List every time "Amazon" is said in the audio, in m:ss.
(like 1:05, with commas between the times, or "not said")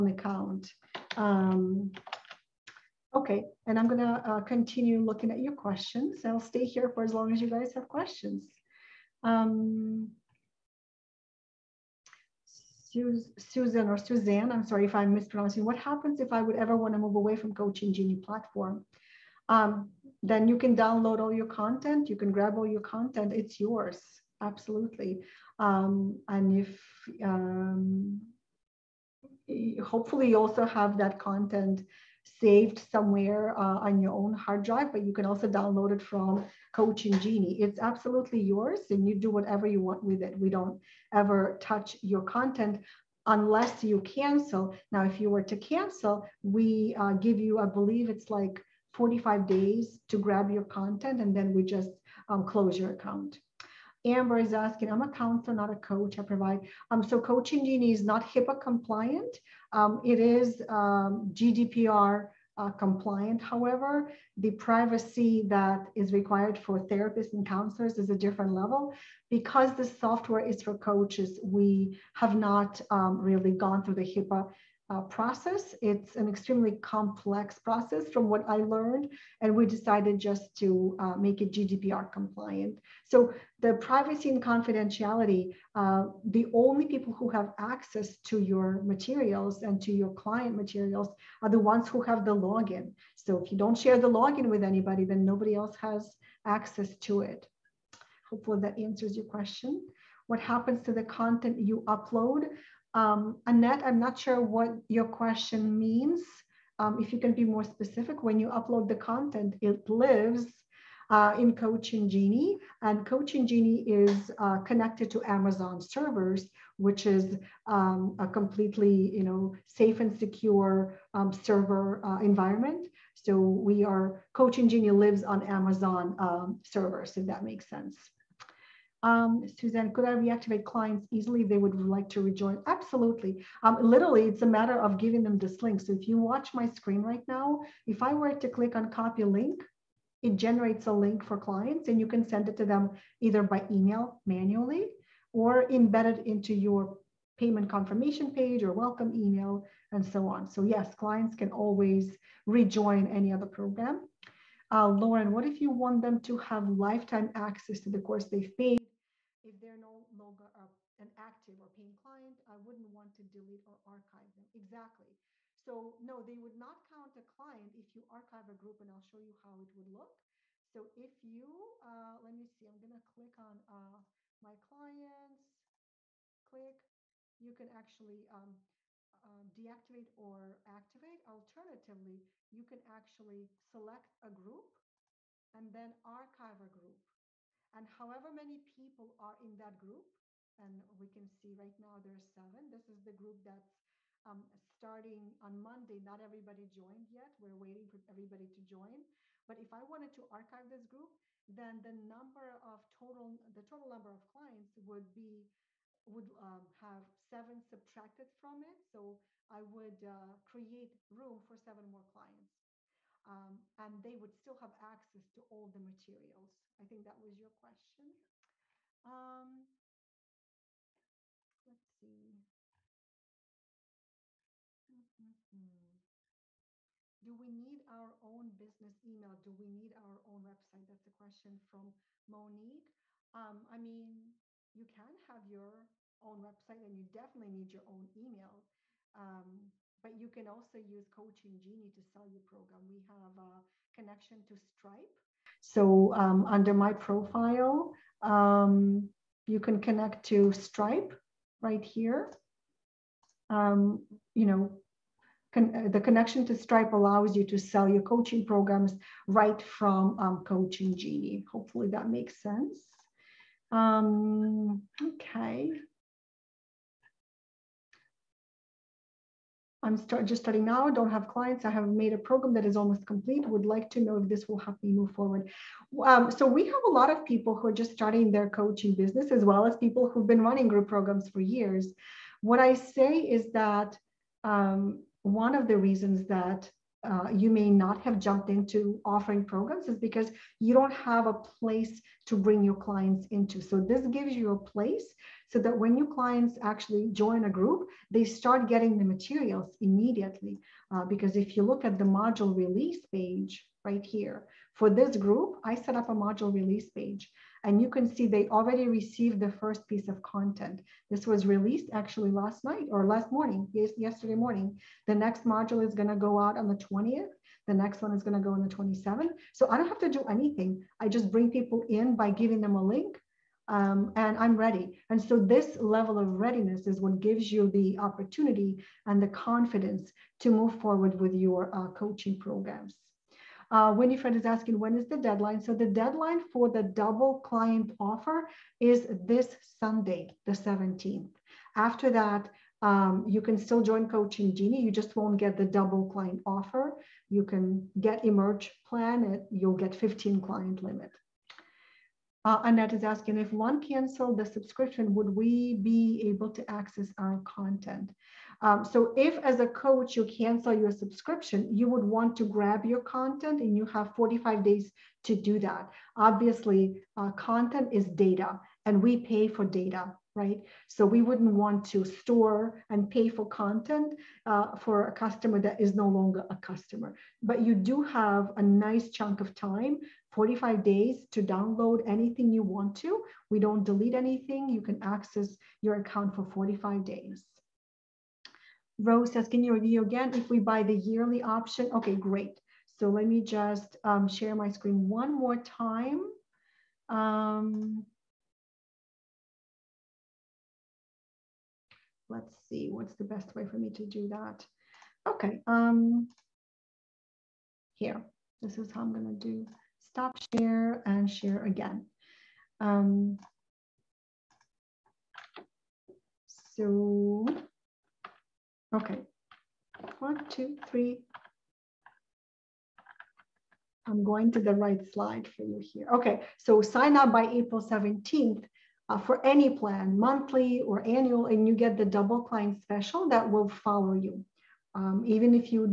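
1:55, 2:05.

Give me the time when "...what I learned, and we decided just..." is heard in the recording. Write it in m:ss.
1:18.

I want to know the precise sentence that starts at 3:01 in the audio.
Alternatively, you can actually select a group and then archive a group.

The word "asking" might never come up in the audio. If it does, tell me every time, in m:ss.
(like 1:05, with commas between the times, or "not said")
0:54, 5:34, 5:53.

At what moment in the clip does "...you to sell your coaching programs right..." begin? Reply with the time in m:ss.
4:17.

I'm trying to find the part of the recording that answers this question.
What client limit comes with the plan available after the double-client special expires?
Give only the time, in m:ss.
5:49.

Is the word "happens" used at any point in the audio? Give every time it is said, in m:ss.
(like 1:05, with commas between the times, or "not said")
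0:15, 1:40.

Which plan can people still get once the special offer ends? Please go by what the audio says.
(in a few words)
Emerge.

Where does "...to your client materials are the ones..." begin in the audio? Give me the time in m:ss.
1:29.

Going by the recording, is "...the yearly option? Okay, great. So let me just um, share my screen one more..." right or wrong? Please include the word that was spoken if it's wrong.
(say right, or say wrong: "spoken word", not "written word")
right.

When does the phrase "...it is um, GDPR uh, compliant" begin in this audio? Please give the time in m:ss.
1:00.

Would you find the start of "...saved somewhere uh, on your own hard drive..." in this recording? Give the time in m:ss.
0:32.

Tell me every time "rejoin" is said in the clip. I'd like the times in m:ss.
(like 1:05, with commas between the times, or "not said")
2:12, 2:32.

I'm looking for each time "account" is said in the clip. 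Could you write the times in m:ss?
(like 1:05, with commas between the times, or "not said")
0:00, 0:52, 6:25.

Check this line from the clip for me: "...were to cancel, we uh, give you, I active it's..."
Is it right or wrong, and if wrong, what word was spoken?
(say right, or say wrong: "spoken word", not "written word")
wrong: "believe", not "active".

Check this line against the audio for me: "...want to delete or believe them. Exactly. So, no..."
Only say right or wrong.
wrong.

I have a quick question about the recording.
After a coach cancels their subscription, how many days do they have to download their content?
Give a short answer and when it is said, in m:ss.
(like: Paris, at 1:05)
45 days, at 6:04.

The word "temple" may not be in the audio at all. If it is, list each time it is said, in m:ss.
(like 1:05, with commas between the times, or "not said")
not said.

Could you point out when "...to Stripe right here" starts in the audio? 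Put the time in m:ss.
4:10.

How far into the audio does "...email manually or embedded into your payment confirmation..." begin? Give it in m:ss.
2:23.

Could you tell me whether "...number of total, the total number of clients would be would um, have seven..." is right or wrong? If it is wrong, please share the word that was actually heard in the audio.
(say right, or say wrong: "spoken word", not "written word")
right.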